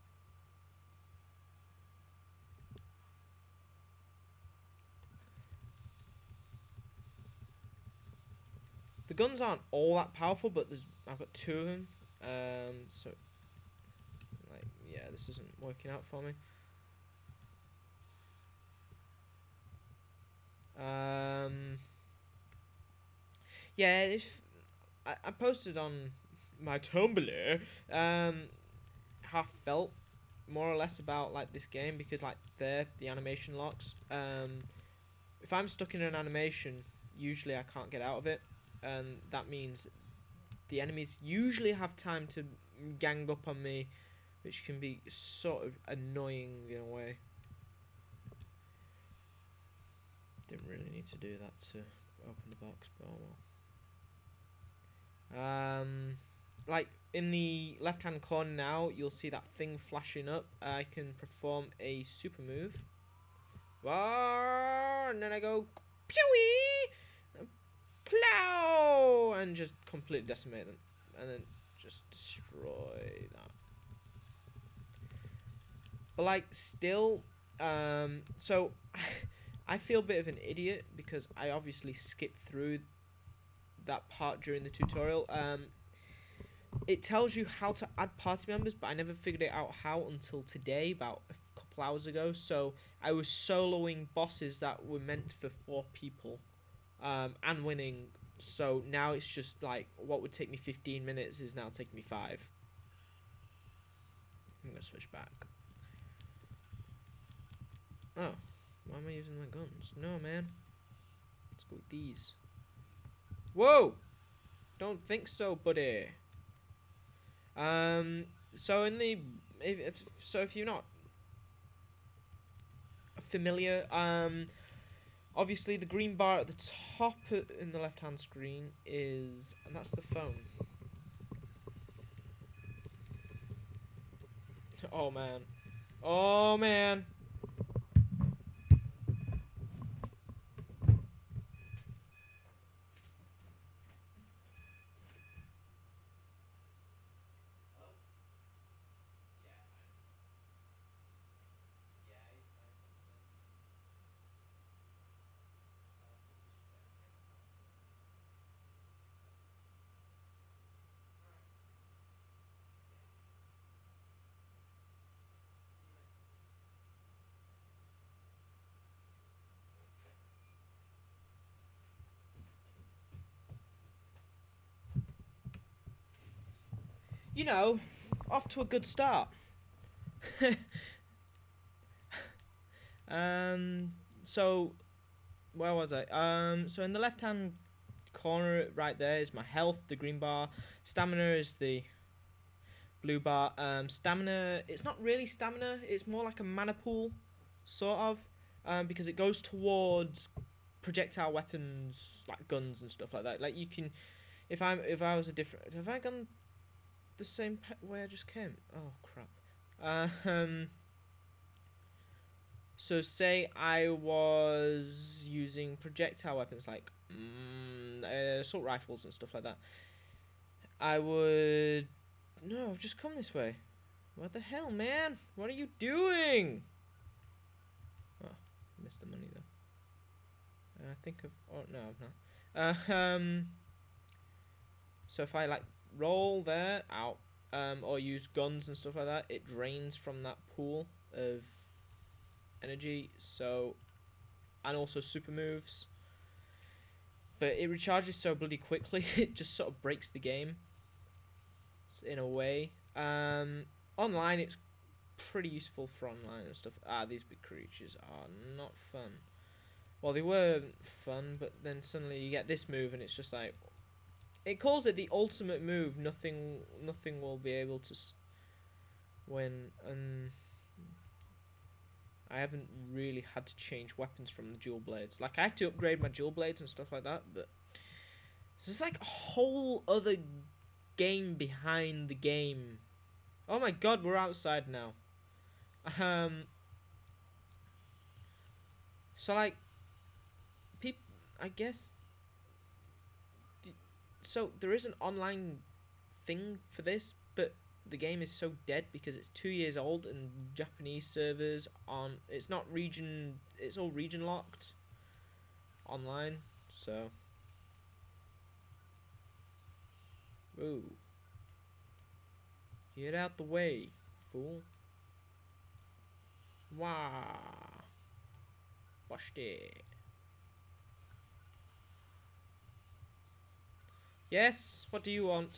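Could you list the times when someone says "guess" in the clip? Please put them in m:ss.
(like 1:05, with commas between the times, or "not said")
4:51.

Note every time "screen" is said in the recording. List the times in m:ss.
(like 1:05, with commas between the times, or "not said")
2:08.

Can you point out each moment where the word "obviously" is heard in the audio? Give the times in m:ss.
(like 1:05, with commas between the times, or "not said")
1:21, 2:05.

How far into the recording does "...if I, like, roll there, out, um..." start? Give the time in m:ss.
3:55.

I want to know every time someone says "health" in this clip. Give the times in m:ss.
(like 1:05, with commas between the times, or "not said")
3:09.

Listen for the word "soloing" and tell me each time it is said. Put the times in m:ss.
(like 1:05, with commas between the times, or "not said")
1:33.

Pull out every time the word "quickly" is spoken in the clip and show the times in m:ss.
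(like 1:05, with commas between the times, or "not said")
4:08.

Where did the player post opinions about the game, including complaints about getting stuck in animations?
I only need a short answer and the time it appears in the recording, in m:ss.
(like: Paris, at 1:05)
Tumblr, at 0:26.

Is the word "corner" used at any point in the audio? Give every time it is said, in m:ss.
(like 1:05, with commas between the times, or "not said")
0:58, 3:08.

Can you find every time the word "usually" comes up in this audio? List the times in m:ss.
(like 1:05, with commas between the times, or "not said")
0:37, 0:41.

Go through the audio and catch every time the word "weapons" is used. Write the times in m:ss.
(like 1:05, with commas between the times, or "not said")
3:21, 3:36, 4:33.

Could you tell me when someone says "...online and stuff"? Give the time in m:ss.
4:16.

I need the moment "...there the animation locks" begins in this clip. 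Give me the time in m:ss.
0:32.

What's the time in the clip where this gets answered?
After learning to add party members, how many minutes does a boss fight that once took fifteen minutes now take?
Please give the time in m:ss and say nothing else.
1:42.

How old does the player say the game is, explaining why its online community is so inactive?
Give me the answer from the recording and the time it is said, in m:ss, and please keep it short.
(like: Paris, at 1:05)
2 years, at 4:59.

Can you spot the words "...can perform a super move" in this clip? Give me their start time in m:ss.
1:00.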